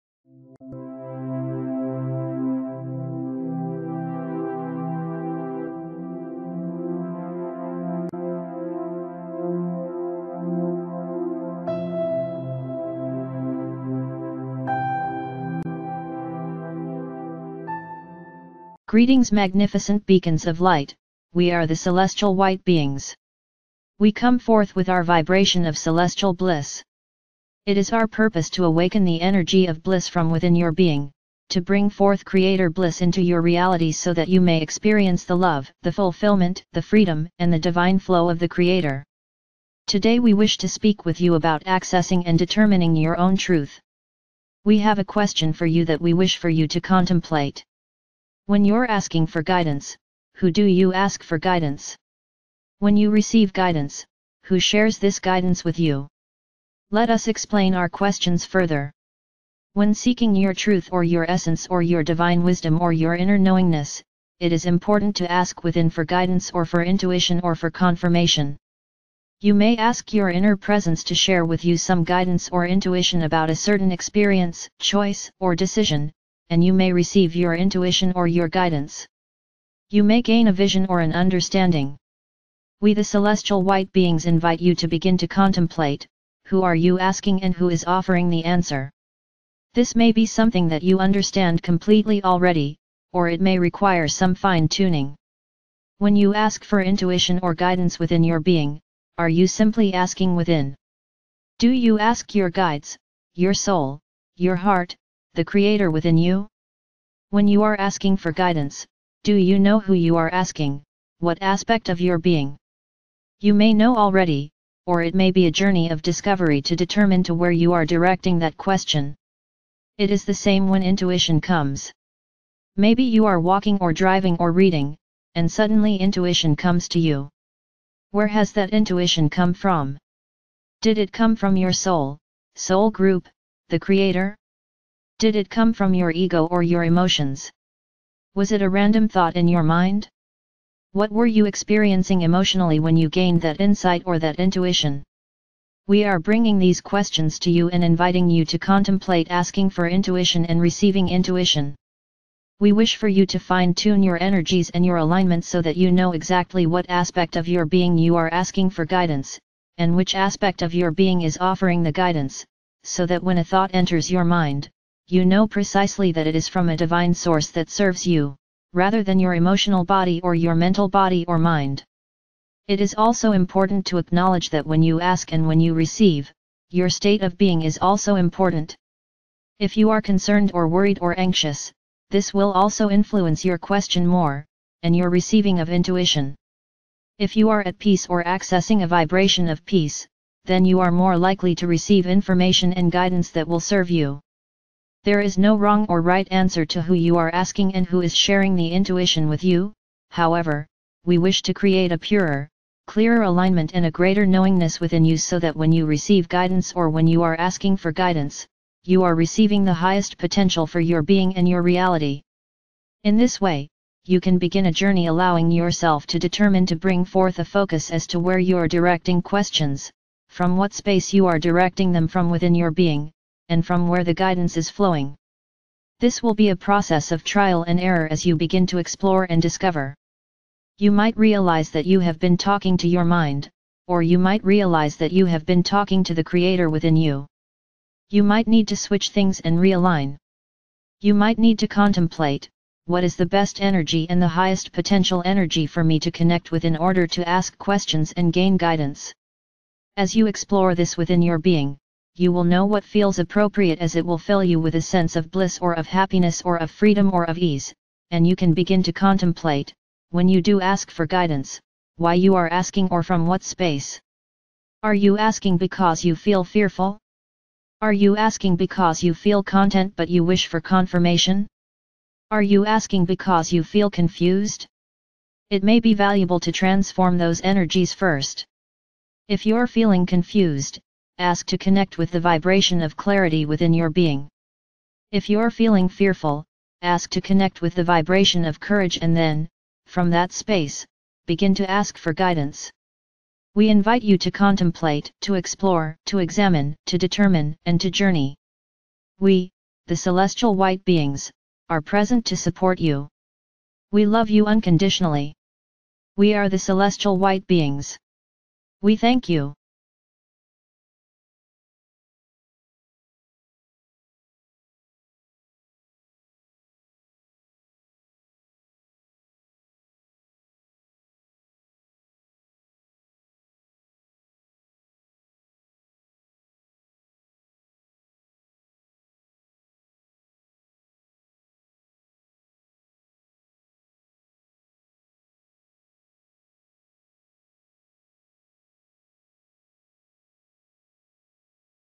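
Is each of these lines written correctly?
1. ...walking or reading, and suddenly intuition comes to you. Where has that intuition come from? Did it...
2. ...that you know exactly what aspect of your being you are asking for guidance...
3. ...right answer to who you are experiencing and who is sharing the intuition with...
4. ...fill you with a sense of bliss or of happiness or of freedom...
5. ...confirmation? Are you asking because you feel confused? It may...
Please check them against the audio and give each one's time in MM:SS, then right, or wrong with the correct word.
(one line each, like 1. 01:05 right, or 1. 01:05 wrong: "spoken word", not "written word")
1. 02:03 wrong: "driving", not "walking"
2. 02:35 right
3. 03:15 wrong: "asking", not "experiencing"
4. 04:14 right
5. 04:30 right.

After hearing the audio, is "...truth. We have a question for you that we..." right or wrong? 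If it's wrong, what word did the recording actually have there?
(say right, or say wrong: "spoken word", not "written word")
right.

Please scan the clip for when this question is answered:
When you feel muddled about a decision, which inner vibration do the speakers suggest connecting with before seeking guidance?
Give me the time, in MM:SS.
04:42.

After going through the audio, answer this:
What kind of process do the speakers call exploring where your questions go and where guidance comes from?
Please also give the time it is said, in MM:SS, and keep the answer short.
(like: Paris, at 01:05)
trial and error, at 03:47.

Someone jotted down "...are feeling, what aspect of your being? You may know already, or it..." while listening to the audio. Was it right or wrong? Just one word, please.
wrong.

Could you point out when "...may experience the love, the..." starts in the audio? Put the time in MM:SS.
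00:34.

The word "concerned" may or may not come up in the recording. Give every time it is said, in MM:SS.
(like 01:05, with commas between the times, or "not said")
03:00.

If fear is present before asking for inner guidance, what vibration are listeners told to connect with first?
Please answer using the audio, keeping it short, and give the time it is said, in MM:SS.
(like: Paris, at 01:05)
courage, at 04:48.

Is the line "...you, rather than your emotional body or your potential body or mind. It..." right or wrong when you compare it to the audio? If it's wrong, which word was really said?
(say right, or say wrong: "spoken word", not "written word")
wrong: "mental", not "potential".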